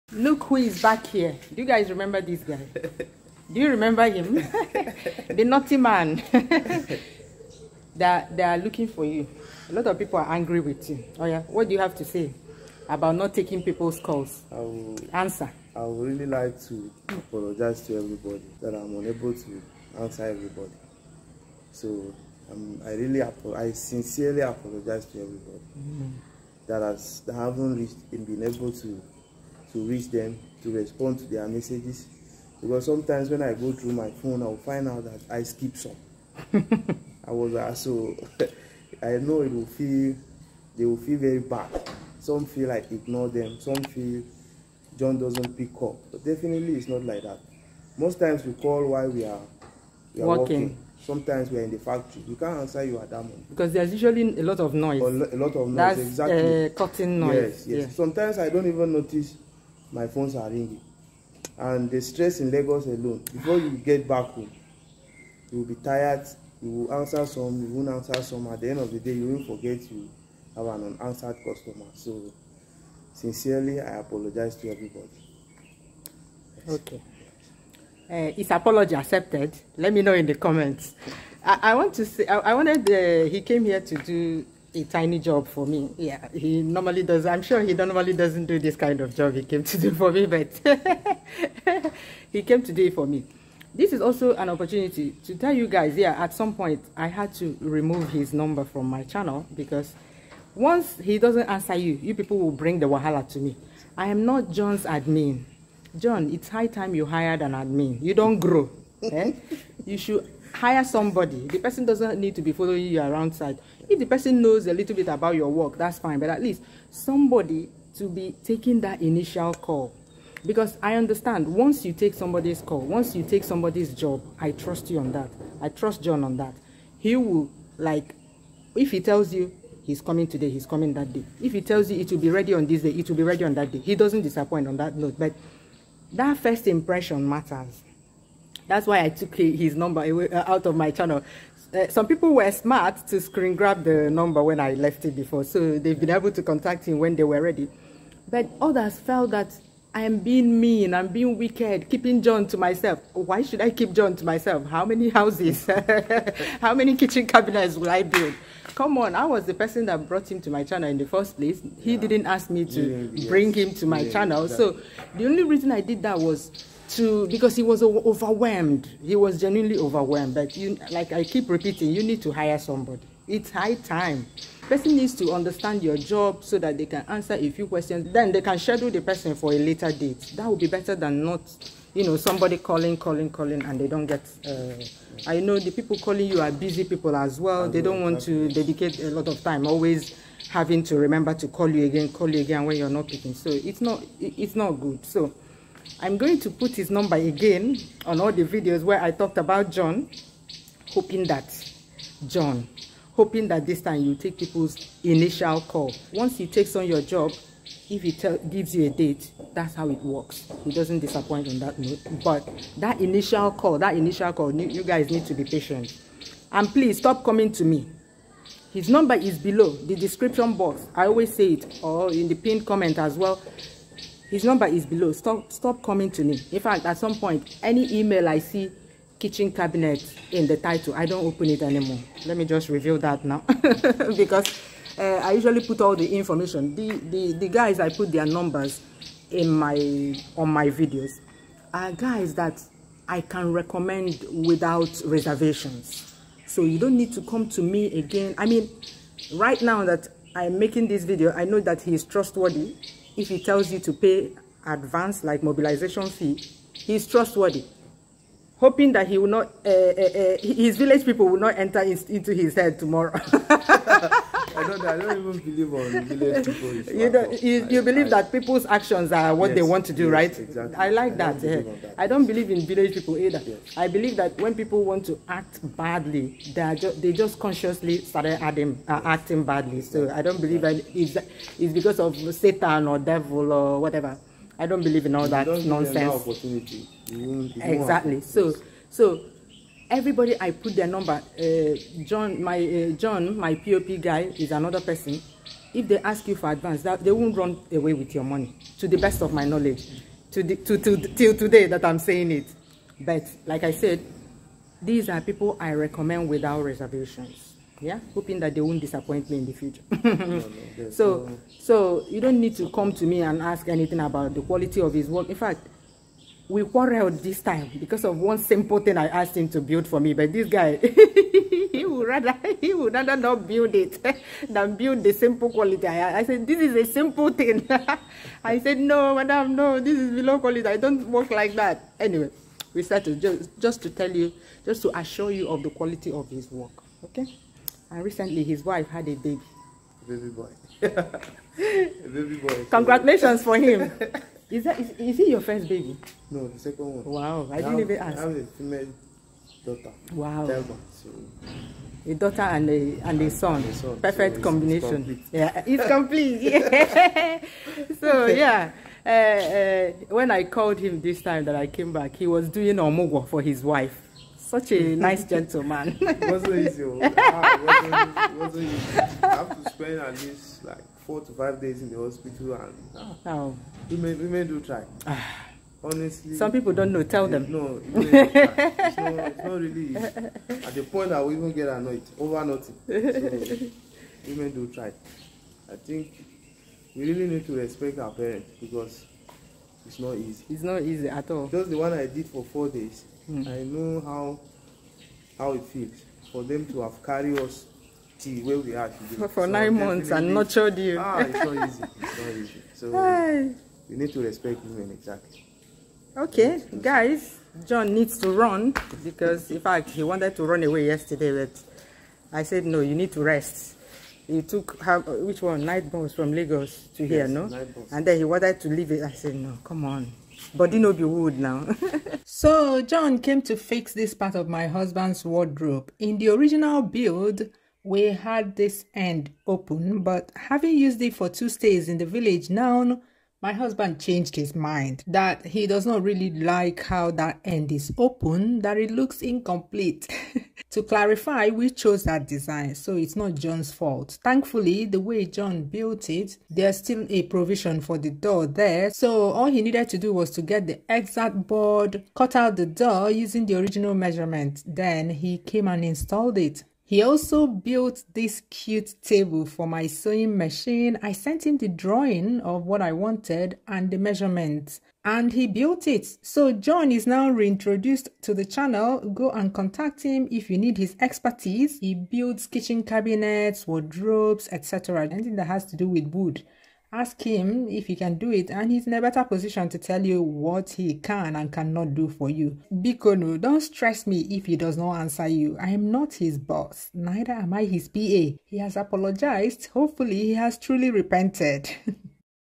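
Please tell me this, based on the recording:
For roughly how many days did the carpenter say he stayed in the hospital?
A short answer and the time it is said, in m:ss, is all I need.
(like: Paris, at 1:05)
4 to 5 days, at 6:11.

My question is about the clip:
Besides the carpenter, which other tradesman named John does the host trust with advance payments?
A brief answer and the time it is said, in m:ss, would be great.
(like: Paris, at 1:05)
POP guy, at 4:53.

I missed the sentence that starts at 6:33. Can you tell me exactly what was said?
I know how how it feels for them to have carried us to where we are today.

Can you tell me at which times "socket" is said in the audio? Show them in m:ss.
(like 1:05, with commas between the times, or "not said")
not said.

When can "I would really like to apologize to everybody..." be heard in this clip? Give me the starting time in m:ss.
0:15.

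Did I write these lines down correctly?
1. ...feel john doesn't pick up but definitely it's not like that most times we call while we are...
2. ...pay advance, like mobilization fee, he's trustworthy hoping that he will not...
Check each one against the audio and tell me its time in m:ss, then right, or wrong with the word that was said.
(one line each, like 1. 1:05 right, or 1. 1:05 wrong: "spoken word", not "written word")
1. 0:43 right
2. 4:13 right.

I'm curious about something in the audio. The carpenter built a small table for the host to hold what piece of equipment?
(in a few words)
sewing machine.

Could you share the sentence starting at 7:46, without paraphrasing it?
So John is now reintroduced to the channel.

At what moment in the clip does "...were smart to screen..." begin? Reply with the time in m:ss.
2:22.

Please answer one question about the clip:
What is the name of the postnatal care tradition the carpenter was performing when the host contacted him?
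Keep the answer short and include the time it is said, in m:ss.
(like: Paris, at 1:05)
omugwo, at 6:02.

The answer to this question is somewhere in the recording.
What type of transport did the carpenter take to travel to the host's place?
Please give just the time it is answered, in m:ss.
6:55.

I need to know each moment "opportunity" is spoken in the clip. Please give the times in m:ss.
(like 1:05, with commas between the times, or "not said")
1:34.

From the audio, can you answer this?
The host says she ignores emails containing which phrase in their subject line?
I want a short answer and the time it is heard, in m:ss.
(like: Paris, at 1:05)
kitchen cabinet, at 3:49.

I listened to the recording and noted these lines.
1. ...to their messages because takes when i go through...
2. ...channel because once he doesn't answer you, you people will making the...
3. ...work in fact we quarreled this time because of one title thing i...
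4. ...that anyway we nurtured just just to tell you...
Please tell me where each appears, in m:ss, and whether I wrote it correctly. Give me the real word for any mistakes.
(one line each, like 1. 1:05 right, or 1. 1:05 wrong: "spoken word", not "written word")
1. 0:31 wrong: "sometimes", not "takes"
2. 1:39 wrong: "bring", not "making"
3. 5:15 wrong: "simple", not "title"
4. 5:31 wrong: "started", not "nurtured".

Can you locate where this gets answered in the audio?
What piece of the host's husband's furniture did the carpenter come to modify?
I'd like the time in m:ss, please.
7:05.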